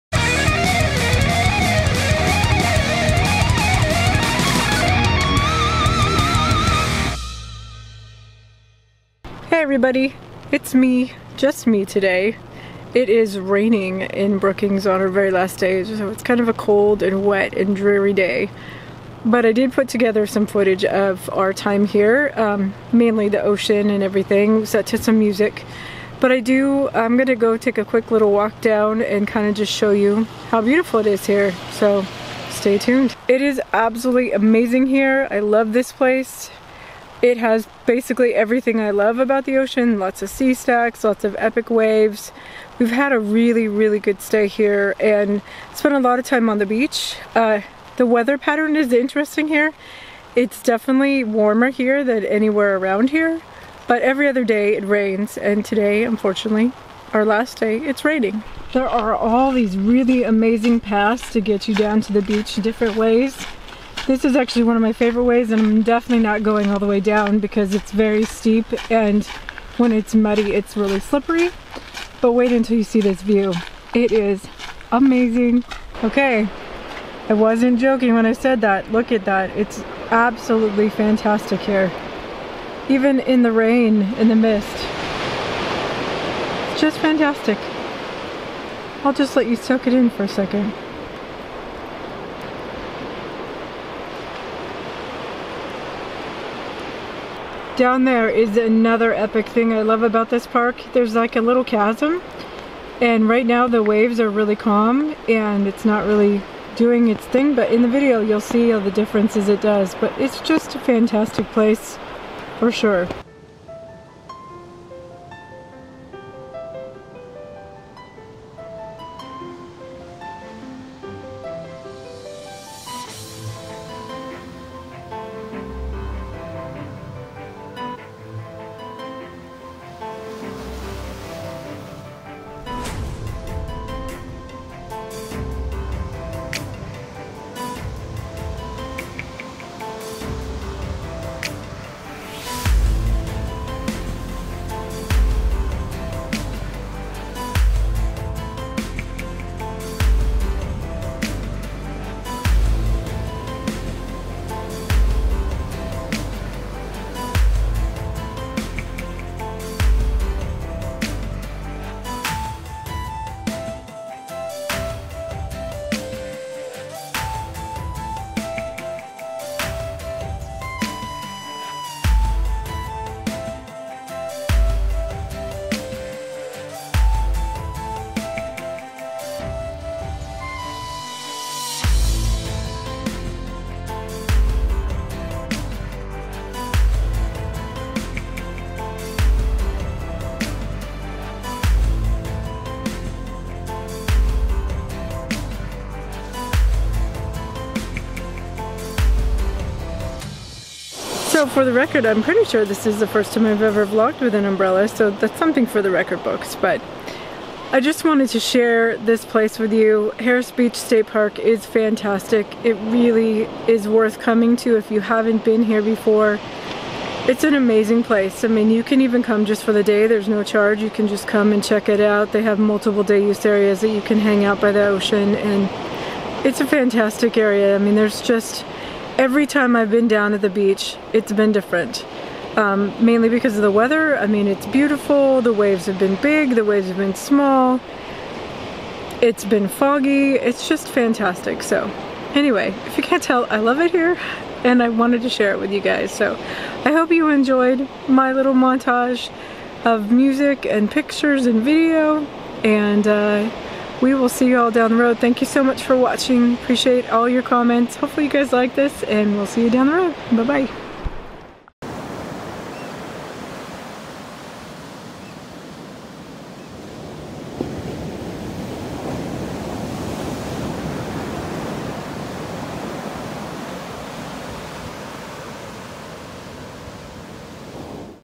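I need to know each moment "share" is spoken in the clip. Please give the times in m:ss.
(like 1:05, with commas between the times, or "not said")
3:28, 4:05.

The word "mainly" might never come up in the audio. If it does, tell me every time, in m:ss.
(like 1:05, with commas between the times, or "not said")
0:22, 3:53.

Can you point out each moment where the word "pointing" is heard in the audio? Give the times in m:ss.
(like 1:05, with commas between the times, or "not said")
not said.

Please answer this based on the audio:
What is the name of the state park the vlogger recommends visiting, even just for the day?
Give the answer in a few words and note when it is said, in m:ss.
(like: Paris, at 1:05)
Harris Beach State Park, at 3:30.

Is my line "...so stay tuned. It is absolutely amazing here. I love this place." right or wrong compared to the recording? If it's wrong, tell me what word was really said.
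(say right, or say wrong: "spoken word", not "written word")
right.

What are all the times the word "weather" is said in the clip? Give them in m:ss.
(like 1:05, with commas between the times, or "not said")
0:48, 3:53.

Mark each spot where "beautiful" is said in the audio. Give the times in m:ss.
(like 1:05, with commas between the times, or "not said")
0:30, 3:54.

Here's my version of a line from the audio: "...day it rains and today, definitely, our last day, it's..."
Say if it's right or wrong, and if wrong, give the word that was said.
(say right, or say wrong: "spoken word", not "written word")
wrong: "unfortunately", not "definitely".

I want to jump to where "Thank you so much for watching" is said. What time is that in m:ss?
4:15.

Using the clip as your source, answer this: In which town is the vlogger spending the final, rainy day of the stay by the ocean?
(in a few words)
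Brookings.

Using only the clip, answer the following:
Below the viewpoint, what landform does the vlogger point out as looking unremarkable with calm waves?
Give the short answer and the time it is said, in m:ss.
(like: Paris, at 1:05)
A little chasm, at 1:41.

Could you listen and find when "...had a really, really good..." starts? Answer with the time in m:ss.
0:42.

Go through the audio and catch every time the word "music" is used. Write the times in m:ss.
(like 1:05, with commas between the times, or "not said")
0:25, 4:10.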